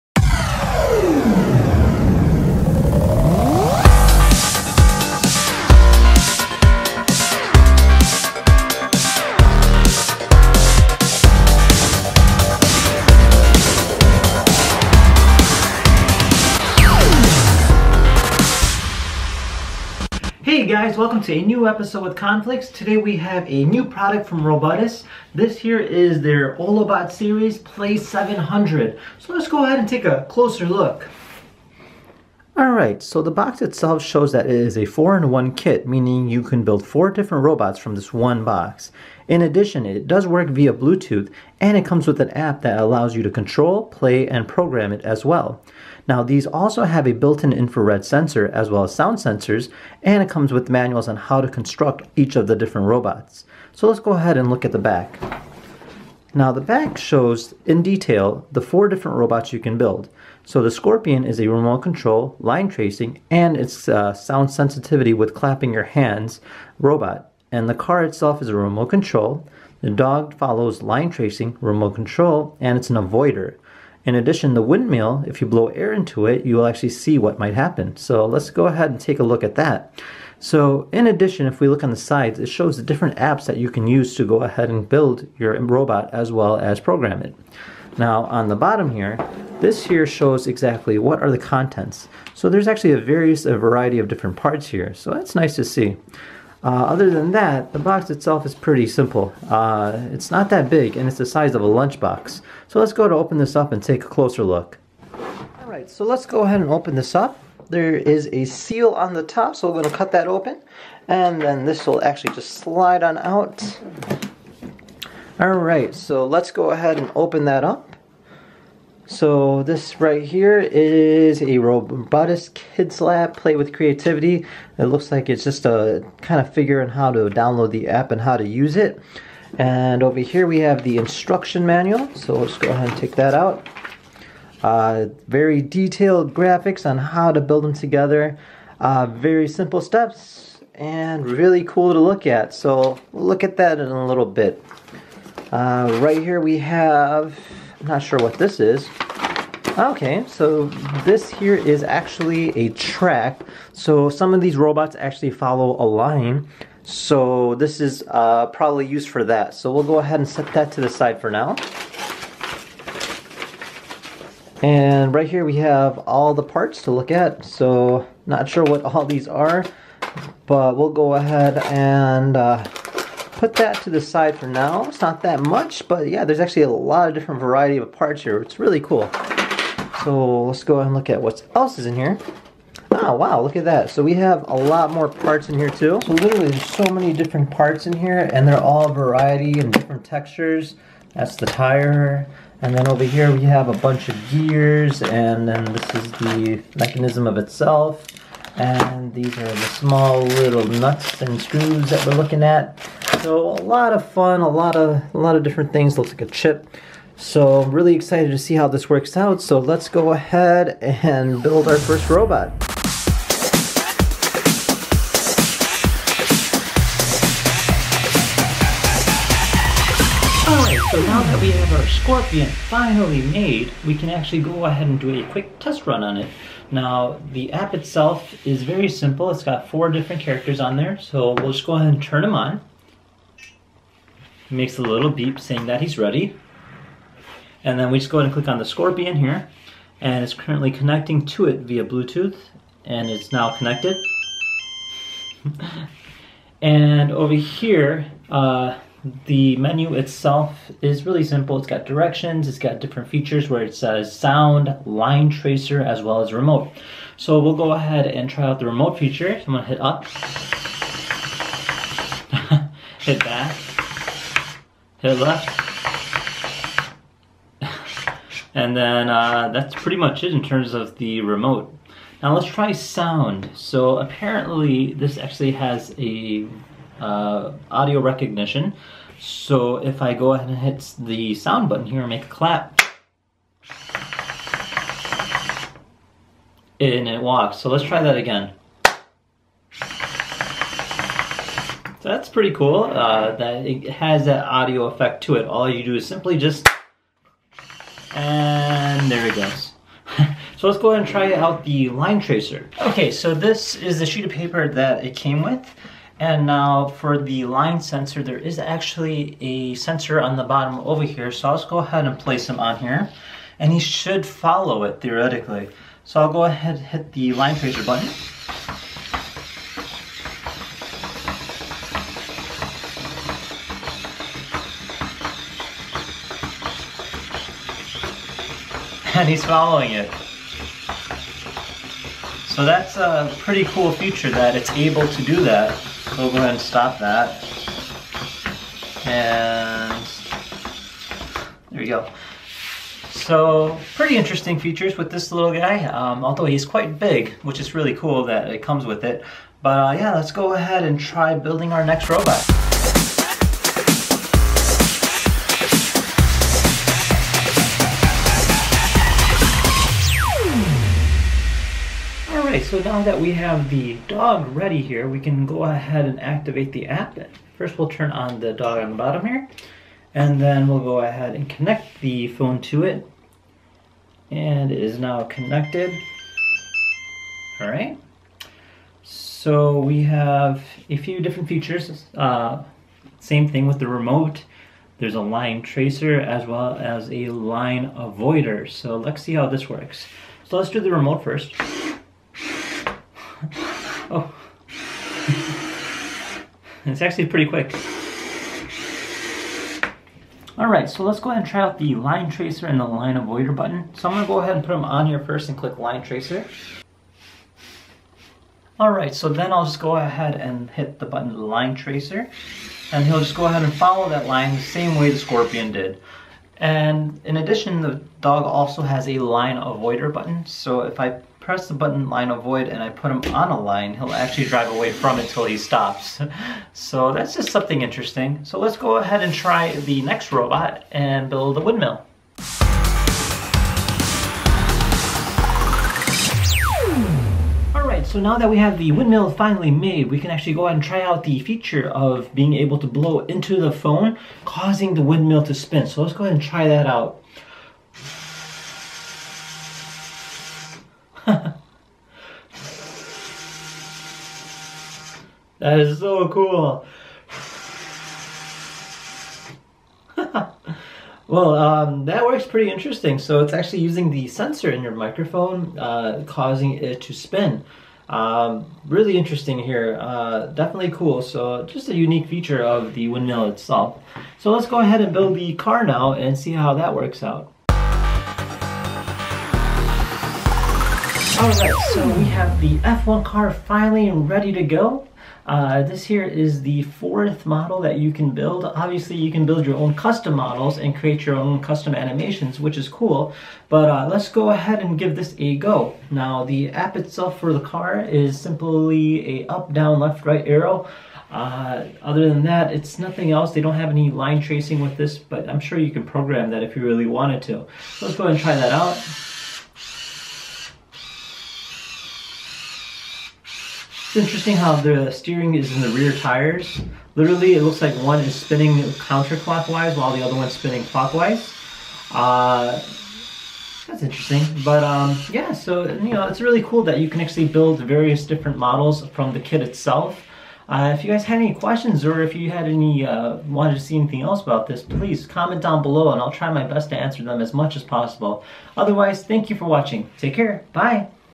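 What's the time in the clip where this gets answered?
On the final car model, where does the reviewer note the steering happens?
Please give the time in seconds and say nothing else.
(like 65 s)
515 s.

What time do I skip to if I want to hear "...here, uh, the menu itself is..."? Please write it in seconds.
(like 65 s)
247 s.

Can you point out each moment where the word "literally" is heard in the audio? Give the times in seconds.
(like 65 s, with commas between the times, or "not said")
186 s, 517 s.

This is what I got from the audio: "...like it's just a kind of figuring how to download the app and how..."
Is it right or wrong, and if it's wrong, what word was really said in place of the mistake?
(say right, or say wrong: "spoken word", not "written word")
right.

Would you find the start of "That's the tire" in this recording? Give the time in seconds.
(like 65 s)
191 s.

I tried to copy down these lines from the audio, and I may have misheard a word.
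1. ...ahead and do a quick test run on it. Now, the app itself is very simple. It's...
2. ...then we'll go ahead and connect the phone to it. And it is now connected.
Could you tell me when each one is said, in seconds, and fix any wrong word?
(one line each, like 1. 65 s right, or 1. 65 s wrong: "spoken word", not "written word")
1. 224 s right
2. 370 s right.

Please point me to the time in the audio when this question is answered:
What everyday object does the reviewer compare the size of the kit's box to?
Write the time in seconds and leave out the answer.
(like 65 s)
101 s.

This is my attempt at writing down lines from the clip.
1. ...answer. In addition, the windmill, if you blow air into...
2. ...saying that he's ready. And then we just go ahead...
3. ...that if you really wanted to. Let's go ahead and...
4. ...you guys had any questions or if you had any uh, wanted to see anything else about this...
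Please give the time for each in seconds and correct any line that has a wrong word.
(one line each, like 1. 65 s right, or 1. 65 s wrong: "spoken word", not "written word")
1. 72 s wrong: "avoider", not "answer"
2. 235 s right
3. 506 s right
4. 531 s right.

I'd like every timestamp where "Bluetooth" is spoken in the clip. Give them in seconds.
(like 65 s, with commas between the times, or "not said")
40 s, 241 s.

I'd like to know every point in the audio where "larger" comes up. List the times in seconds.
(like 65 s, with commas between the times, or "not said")
not said.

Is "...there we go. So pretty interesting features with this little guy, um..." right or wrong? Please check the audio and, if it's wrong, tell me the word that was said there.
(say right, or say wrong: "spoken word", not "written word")
right.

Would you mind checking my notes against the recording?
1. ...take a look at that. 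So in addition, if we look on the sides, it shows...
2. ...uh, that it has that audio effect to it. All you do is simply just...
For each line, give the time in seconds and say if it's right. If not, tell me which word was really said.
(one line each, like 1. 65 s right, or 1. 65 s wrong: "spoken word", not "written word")
1. 78 s right
2. 292 s right.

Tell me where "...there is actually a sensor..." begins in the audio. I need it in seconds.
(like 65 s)
308 s.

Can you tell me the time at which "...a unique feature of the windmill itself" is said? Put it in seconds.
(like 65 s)
471 s.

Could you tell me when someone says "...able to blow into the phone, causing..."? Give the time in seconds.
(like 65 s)
442 s.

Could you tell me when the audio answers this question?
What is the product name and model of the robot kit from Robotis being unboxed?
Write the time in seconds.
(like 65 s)
26 s.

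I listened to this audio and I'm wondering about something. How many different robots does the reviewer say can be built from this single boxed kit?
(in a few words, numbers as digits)
4.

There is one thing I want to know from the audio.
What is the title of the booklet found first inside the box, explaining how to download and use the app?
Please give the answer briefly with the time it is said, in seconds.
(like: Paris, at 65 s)
Robotis Kids Lab, at 121 s.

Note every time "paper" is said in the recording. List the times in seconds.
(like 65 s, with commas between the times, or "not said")
304 s.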